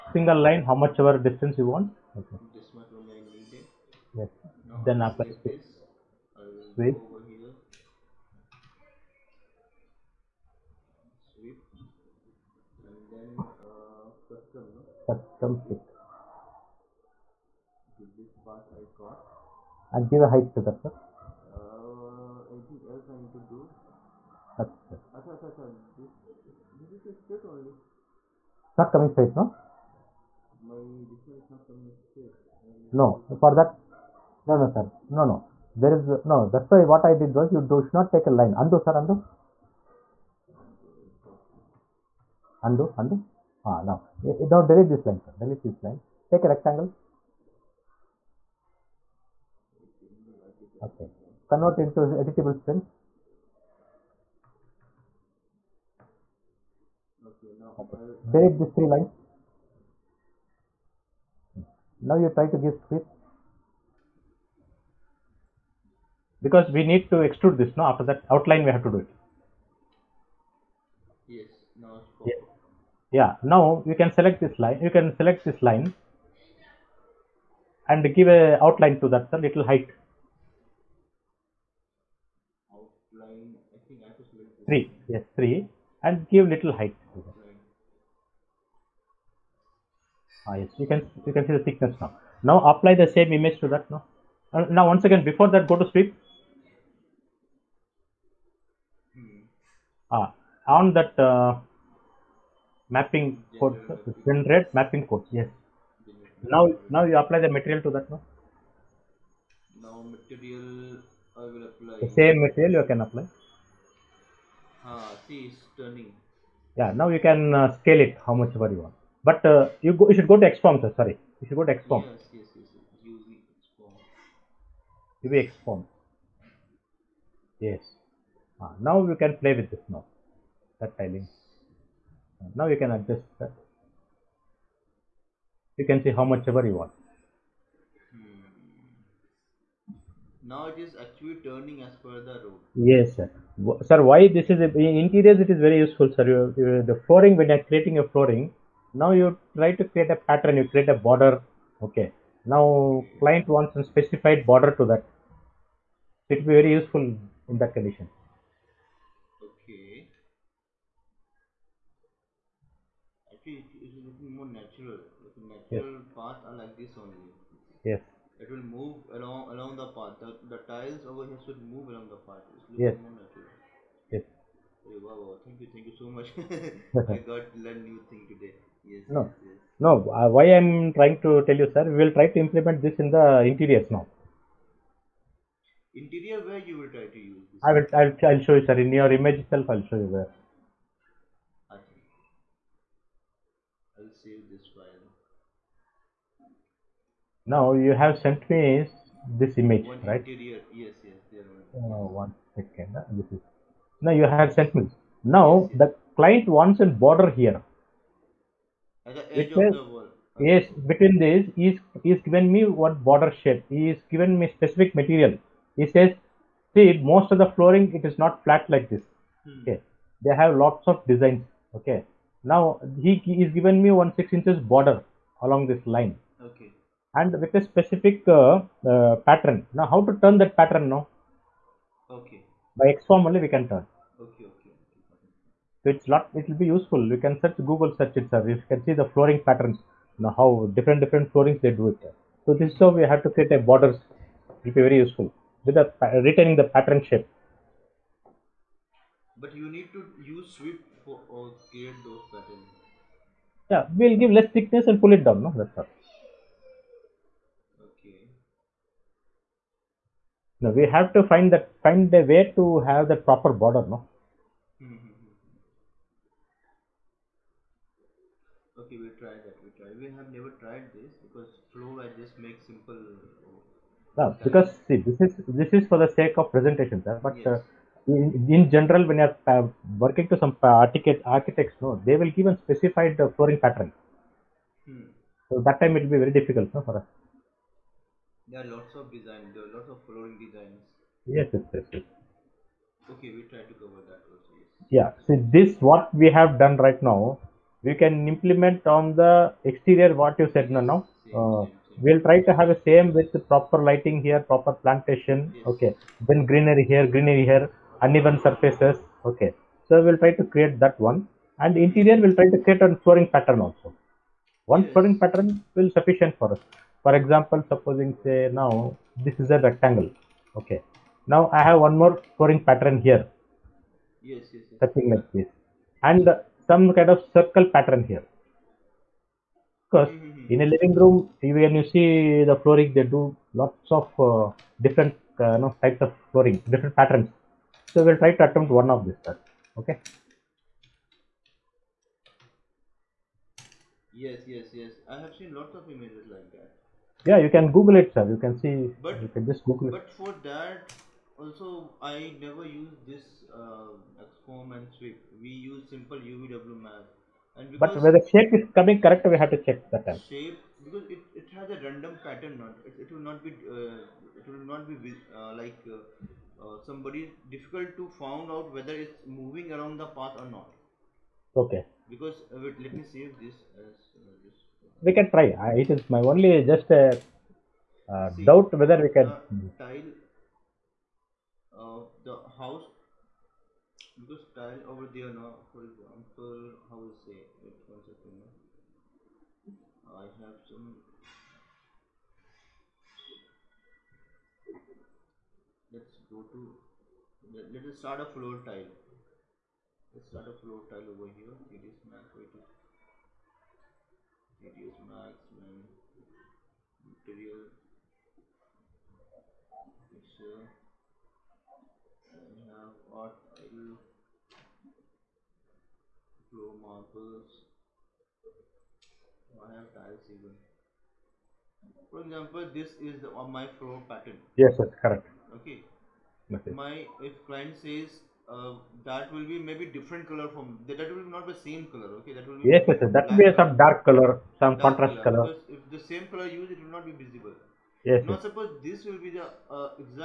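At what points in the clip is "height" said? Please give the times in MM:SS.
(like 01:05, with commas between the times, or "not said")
00:20, 01:19, 01:26.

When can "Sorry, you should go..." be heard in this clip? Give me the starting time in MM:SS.
02:00.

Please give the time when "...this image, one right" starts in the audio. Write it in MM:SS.
03:19.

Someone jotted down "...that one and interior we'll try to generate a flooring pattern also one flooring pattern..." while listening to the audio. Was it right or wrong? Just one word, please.
wrong.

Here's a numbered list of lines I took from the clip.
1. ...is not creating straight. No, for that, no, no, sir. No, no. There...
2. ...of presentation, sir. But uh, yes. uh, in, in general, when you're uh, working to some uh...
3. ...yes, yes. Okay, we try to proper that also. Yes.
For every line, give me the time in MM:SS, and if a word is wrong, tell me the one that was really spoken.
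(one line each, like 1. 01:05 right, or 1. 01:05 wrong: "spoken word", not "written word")
1. 00:31 wrong: "coming", not "creating"
2. 04:36 right
3. 04:51 wrong: "cover", not "proper".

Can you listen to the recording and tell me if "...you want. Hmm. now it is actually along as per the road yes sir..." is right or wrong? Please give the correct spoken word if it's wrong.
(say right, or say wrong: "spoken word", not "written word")
wrong: "turning", not "along".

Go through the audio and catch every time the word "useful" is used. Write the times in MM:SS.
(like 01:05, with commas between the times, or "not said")
02:25, 02:36, 03:56, 04:04.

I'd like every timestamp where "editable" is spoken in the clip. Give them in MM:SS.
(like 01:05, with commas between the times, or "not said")
00:52.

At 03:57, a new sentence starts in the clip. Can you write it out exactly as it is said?
You can search Google search itself.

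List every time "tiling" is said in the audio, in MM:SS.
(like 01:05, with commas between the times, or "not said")
02:10.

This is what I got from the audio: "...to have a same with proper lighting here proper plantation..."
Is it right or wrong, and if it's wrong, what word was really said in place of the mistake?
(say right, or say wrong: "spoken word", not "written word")
right.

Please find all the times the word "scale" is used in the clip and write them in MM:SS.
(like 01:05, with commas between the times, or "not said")
01:57.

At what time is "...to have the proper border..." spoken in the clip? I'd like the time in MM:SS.
04:22.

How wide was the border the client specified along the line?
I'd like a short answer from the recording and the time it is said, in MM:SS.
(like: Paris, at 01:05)
6 inches, at 03:44.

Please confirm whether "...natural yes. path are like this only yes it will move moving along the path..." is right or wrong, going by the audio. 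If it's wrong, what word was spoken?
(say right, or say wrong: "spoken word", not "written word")
wrong: "along", not "moving".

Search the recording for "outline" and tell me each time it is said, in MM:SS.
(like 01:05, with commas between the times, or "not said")
01:08, 01:18, 01:22.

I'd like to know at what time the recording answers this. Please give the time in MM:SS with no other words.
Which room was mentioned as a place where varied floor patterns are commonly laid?
05:30.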